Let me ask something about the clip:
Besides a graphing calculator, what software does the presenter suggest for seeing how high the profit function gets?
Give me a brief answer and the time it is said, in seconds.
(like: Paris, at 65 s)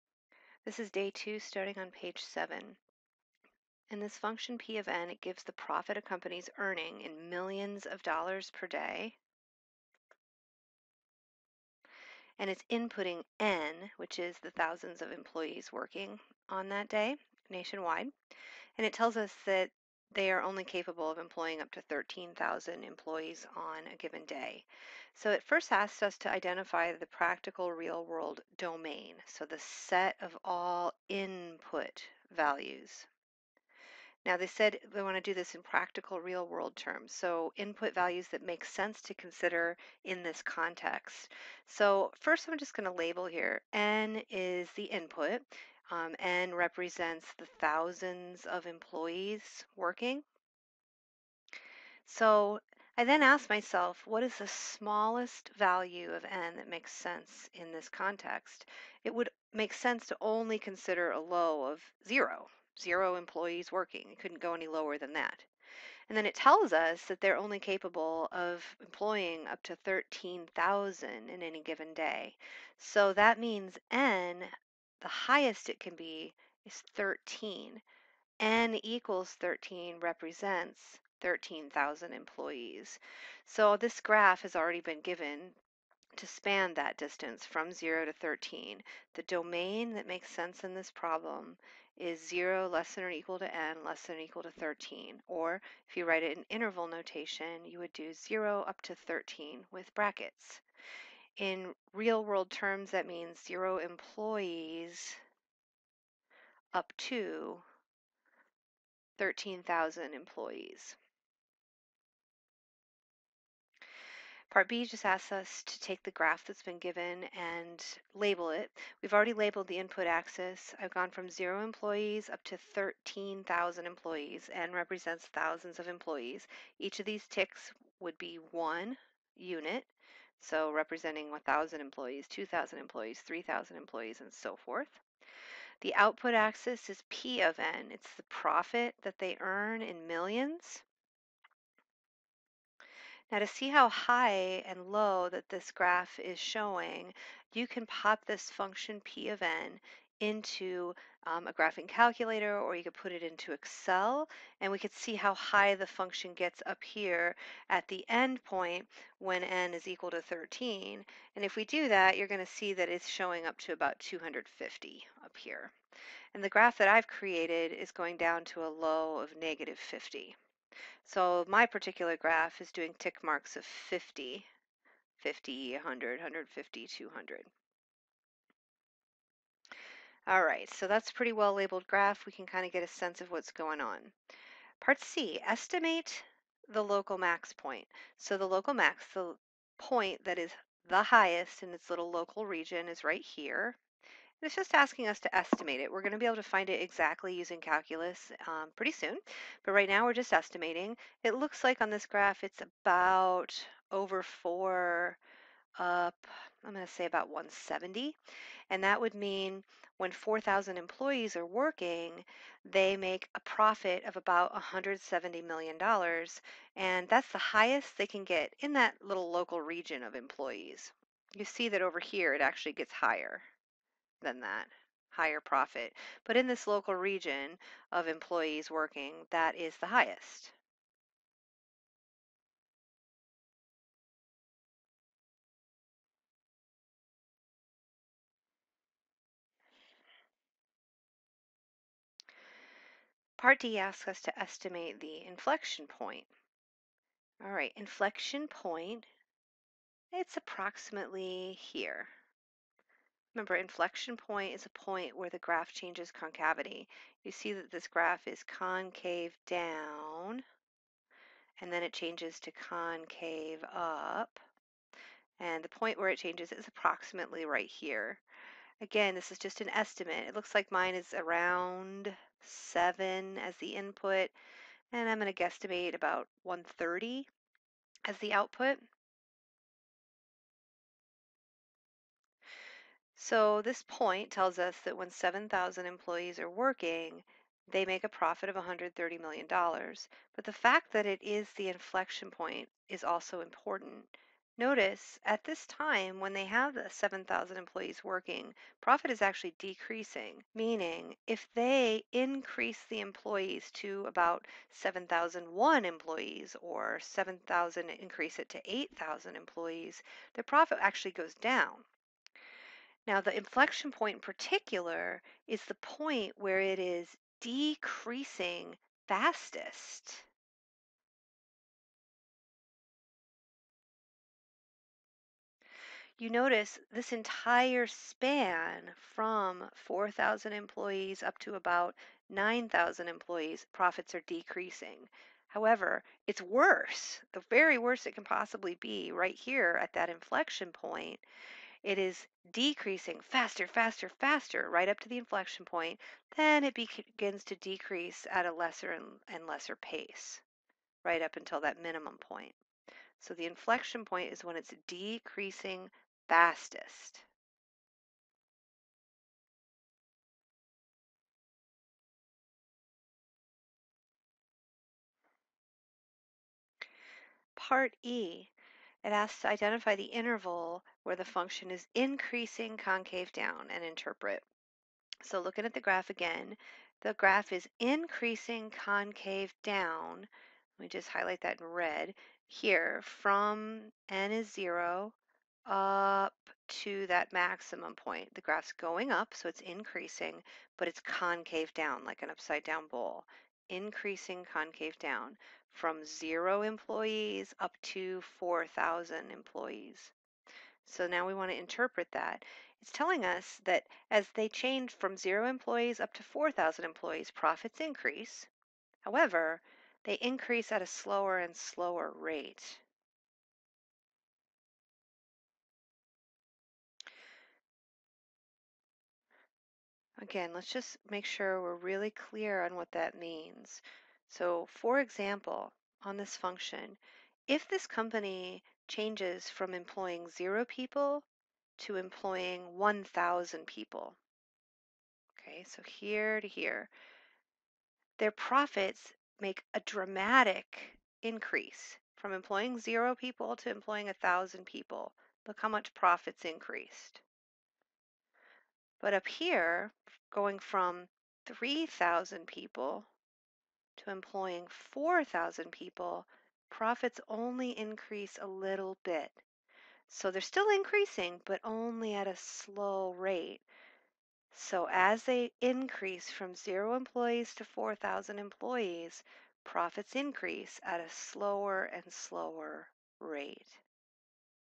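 Excel, at 153 s.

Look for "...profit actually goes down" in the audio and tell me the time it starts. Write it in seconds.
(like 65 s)
310 s.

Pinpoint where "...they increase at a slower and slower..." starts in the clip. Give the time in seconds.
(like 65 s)
410 s.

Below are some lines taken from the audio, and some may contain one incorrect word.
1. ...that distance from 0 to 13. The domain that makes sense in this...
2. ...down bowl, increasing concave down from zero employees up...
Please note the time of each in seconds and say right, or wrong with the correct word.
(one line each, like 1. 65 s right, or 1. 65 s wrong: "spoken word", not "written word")
1. 86 s right
2. 392 s right.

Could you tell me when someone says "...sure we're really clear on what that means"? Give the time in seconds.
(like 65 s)
421 s.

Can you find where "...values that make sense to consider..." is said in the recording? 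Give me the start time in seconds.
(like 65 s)
37 s.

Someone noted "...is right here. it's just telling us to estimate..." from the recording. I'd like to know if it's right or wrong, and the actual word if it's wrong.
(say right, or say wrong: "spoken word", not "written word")
wrong: "asking", not "telling".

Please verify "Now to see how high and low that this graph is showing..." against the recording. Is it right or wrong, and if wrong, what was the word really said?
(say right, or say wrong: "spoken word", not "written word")
right.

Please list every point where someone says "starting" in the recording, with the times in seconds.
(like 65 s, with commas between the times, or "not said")
1 s.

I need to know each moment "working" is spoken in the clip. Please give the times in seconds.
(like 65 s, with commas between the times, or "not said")
15 s, 49 s, 63 s, 211 s, 228 s, 286 s, 298 s.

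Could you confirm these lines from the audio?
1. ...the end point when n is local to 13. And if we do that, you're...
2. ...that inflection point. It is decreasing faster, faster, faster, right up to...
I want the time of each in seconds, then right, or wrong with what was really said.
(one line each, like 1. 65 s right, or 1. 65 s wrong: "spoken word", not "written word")
1. 157 s wrong: "equal", not "local"
2. 339 s right.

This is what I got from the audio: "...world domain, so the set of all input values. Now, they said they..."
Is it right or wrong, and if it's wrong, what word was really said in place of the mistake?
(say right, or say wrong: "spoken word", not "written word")
right.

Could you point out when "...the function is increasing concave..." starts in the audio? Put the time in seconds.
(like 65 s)
371 s.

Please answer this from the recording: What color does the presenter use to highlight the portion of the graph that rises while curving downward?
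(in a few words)
red.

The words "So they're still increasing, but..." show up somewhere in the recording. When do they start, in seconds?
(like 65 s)
460 s.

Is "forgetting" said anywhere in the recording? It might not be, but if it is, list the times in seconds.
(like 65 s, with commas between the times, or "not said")
not said.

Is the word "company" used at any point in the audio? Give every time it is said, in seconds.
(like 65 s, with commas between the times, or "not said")
6 s, 427 s.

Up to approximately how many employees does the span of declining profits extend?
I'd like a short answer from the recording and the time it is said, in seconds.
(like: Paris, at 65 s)
9,000, at 332 s.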